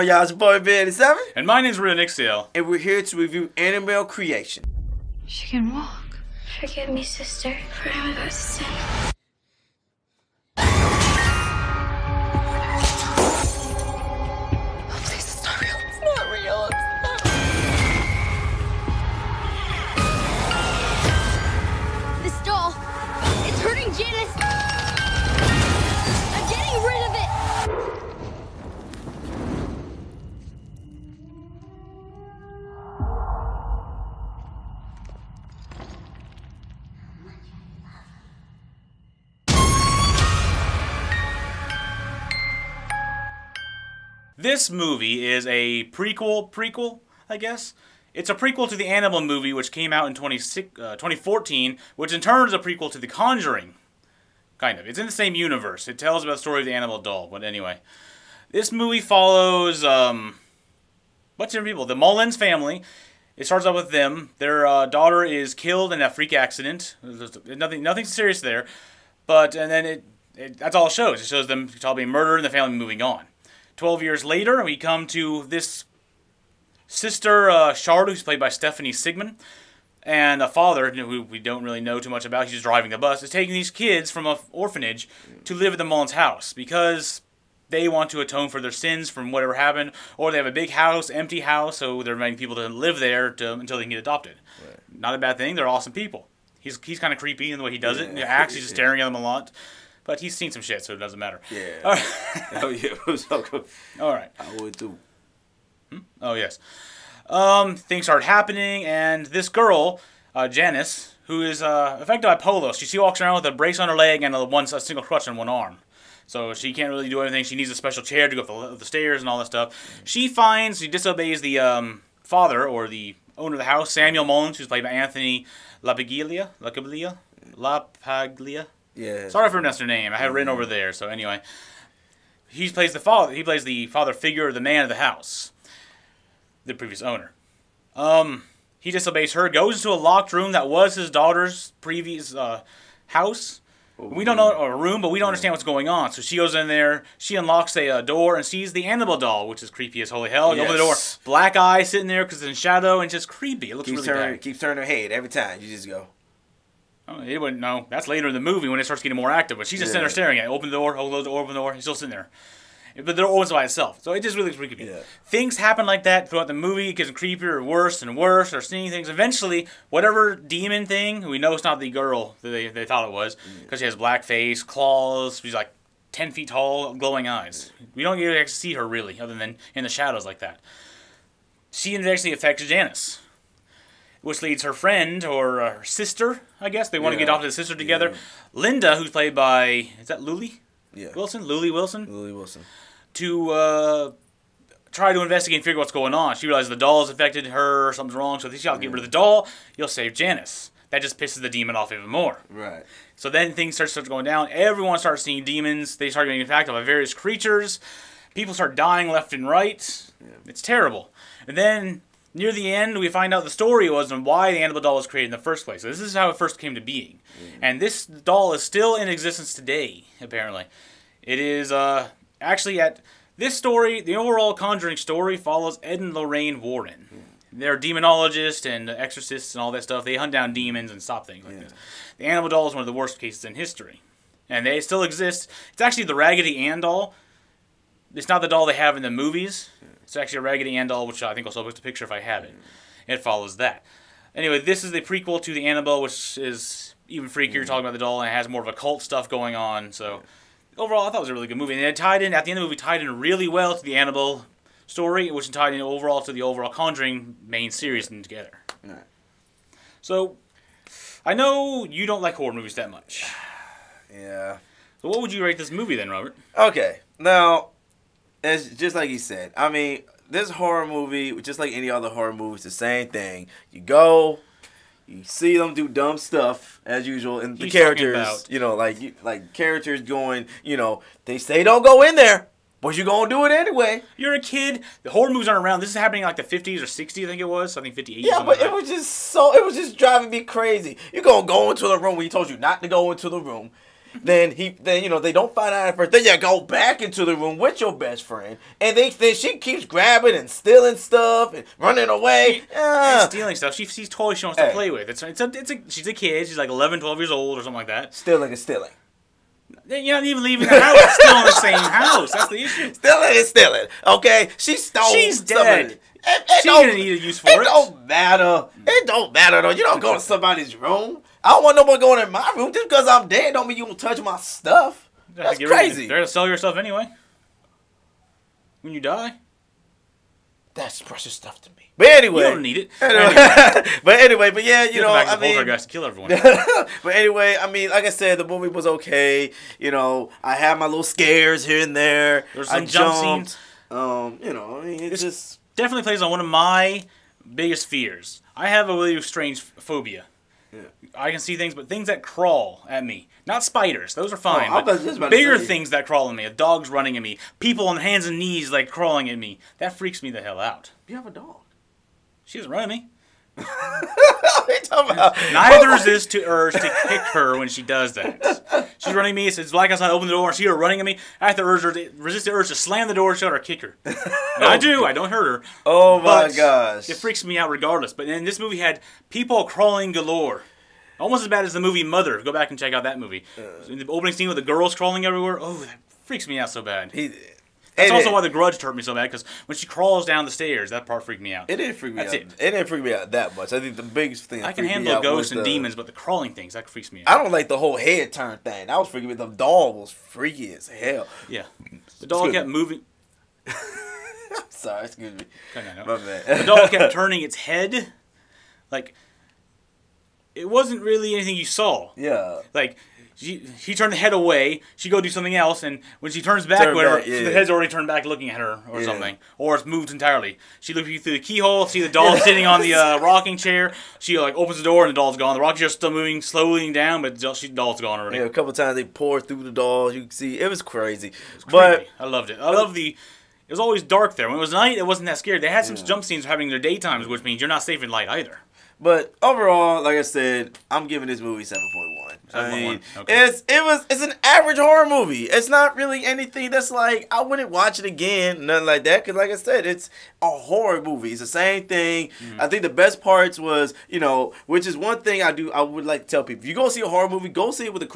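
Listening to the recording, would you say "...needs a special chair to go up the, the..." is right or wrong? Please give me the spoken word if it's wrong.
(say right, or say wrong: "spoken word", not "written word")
right.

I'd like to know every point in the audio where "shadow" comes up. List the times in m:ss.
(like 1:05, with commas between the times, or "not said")
2:32, 2:59.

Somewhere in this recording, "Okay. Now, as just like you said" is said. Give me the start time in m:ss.
4:26.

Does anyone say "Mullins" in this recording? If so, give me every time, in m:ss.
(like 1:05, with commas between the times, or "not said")
1:01, 1:25, 2:04.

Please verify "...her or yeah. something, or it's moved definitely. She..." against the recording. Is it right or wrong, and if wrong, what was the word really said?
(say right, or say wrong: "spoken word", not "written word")
wrong: "entirely", not "definitely".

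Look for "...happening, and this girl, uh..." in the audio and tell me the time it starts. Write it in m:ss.
1:48.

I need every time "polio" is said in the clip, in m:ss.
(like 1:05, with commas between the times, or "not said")
1:52.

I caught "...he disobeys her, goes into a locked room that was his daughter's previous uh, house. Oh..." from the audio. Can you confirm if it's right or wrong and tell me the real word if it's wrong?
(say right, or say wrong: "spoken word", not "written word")
right.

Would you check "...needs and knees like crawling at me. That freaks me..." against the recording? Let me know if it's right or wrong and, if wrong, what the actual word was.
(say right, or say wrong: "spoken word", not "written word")
wrong: "hands", not "needs".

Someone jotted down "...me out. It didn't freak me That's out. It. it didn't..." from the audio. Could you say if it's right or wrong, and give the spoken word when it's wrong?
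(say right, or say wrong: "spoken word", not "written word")
right.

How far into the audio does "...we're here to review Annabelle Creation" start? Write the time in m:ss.
0:02.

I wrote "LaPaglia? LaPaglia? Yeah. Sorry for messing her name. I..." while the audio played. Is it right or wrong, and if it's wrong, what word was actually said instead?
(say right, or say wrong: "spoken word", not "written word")
right.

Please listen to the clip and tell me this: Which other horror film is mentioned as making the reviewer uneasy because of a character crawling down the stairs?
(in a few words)
The Grudge.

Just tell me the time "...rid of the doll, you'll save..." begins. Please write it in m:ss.
3:18.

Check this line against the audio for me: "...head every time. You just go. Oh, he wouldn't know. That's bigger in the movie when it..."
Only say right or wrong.
wrong.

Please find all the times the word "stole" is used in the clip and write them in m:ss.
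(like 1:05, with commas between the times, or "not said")
5:14.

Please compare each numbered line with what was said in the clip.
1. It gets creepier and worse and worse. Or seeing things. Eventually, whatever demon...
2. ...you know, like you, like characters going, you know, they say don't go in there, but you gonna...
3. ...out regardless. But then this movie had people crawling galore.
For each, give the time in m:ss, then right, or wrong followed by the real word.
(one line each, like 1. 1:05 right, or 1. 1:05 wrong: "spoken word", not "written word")
1. 2:46 right
2. 4:38 right
3. 6:17 right.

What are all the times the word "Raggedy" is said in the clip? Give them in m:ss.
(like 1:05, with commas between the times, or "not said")
3:56, 4:00.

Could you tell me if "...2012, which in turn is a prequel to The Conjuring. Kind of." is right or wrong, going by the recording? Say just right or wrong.
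wrong.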